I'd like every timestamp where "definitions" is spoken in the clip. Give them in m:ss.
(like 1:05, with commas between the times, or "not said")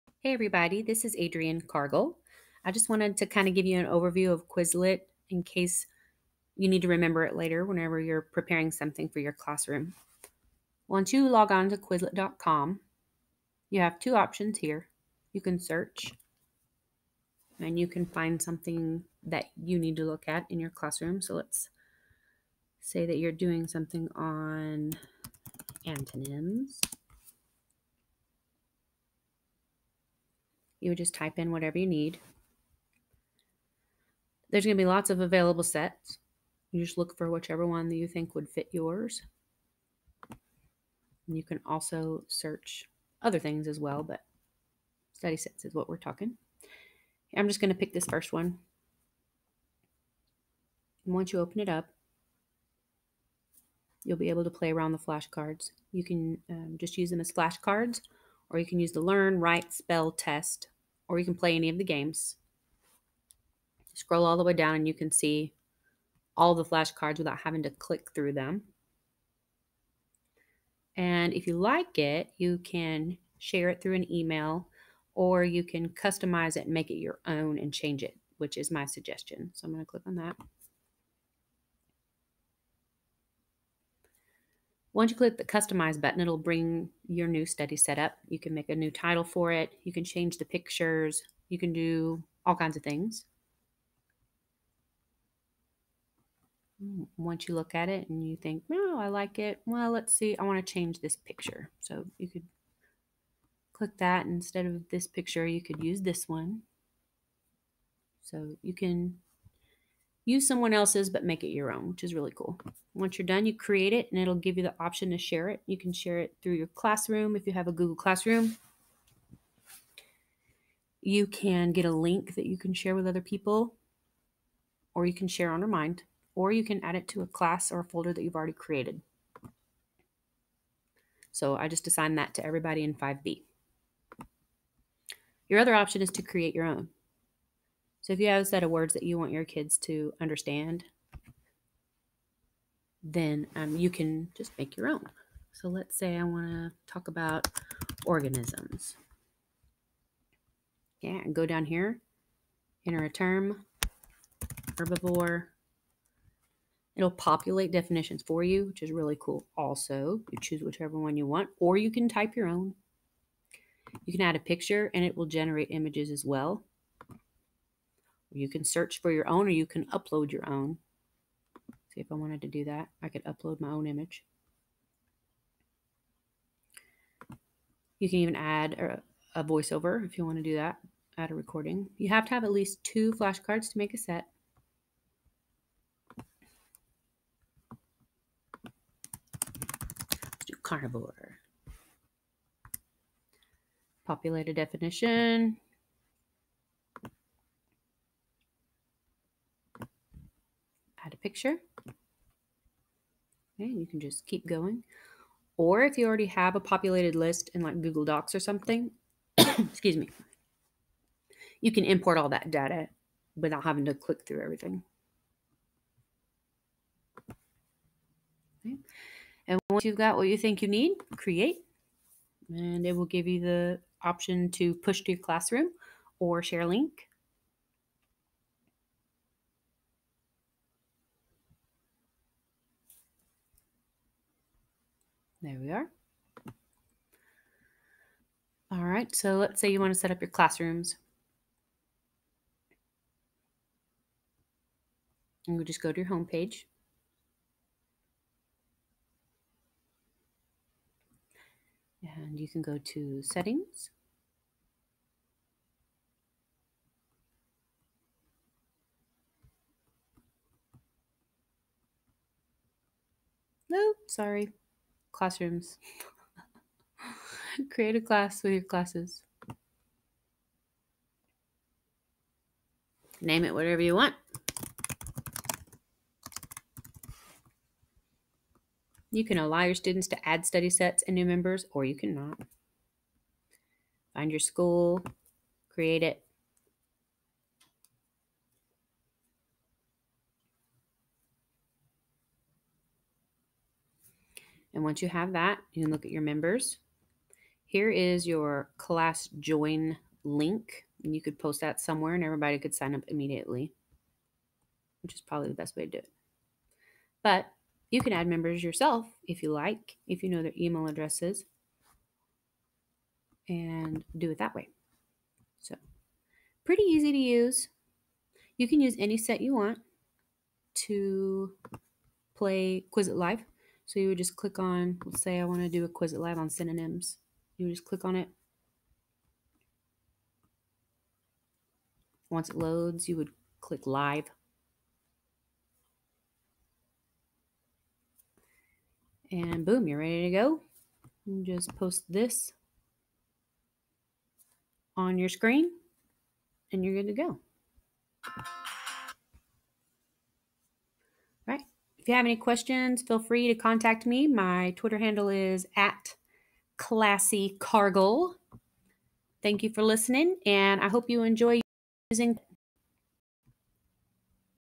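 2:37, 3:14.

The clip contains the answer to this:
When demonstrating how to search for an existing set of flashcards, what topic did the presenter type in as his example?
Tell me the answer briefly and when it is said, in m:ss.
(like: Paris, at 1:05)
antonyms, at 0:25.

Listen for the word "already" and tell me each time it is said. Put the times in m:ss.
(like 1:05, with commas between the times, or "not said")
2:08, 3:26.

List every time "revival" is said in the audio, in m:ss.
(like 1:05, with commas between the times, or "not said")
not said.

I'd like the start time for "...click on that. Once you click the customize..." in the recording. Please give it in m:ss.
1:19.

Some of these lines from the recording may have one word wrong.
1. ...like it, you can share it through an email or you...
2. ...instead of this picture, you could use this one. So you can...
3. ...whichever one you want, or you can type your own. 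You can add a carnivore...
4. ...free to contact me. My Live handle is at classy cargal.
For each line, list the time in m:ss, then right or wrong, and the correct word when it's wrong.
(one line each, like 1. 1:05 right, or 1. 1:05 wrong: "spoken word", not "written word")
1. 1:11 right
2. 1:44 right
3. 2:40 wrong: "picture", not "carnivore"
4. 5:53 wrong: "Twitter", not "Live".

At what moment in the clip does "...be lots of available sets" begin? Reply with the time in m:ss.
0:34.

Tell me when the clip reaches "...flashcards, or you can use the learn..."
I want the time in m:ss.
0:57.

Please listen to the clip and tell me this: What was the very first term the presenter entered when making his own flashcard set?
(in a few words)
herbivore.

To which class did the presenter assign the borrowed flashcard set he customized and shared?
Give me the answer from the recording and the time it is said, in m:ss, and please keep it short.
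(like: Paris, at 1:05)
5B, at 2:12.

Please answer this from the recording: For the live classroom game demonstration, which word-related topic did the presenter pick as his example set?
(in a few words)
synonyms.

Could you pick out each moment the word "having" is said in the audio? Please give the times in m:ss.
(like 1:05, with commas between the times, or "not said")
1:07, 3:33.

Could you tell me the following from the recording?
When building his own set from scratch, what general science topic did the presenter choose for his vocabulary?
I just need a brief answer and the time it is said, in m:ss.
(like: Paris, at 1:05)
organisms, at 2:28.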